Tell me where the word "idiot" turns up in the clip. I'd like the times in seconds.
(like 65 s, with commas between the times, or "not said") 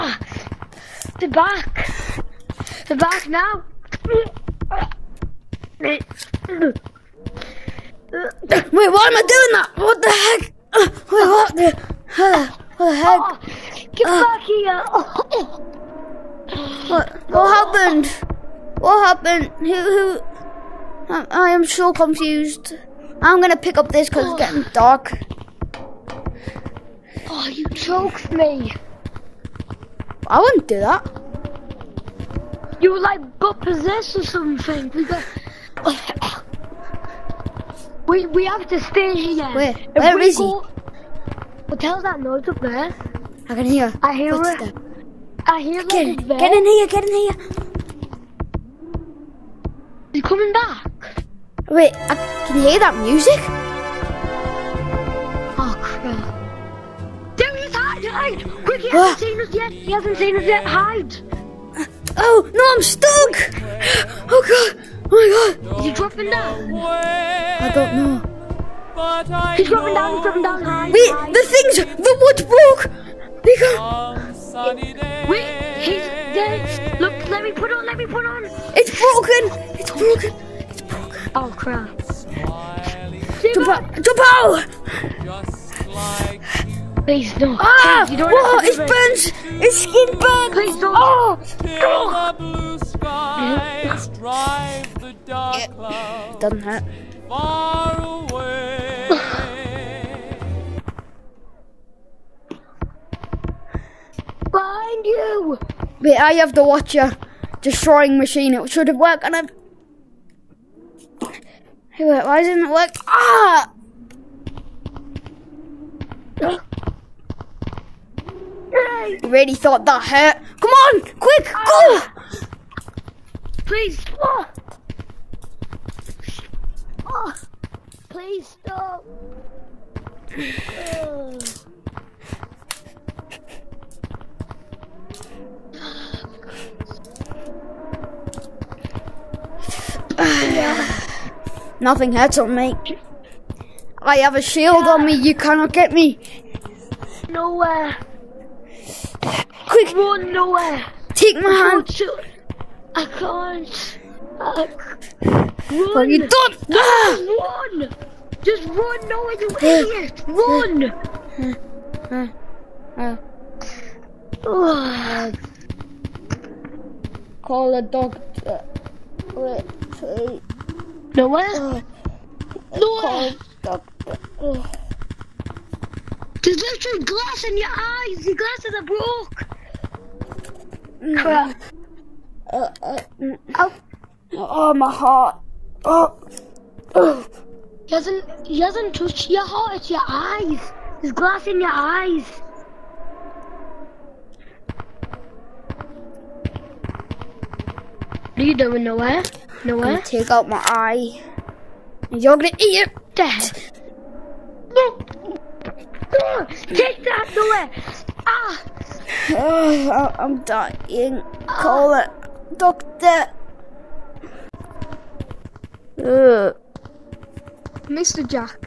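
159 s.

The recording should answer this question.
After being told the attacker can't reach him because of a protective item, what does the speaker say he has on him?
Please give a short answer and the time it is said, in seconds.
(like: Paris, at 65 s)
A shield, at 144 s.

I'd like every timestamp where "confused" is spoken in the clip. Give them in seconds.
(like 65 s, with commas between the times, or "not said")
21 s.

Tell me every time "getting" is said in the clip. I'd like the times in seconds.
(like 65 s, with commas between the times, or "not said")
24 s.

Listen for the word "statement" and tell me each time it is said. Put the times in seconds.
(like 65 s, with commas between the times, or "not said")
not said.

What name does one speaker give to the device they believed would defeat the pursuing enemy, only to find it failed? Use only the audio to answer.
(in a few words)
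Watcher destroying machine.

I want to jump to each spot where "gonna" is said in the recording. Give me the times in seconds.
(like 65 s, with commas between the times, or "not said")
23 s, 202 s.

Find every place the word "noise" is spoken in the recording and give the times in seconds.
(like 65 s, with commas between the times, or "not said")
42 s.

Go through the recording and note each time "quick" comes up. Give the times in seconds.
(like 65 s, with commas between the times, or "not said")
58 s, 121 s, 149 s.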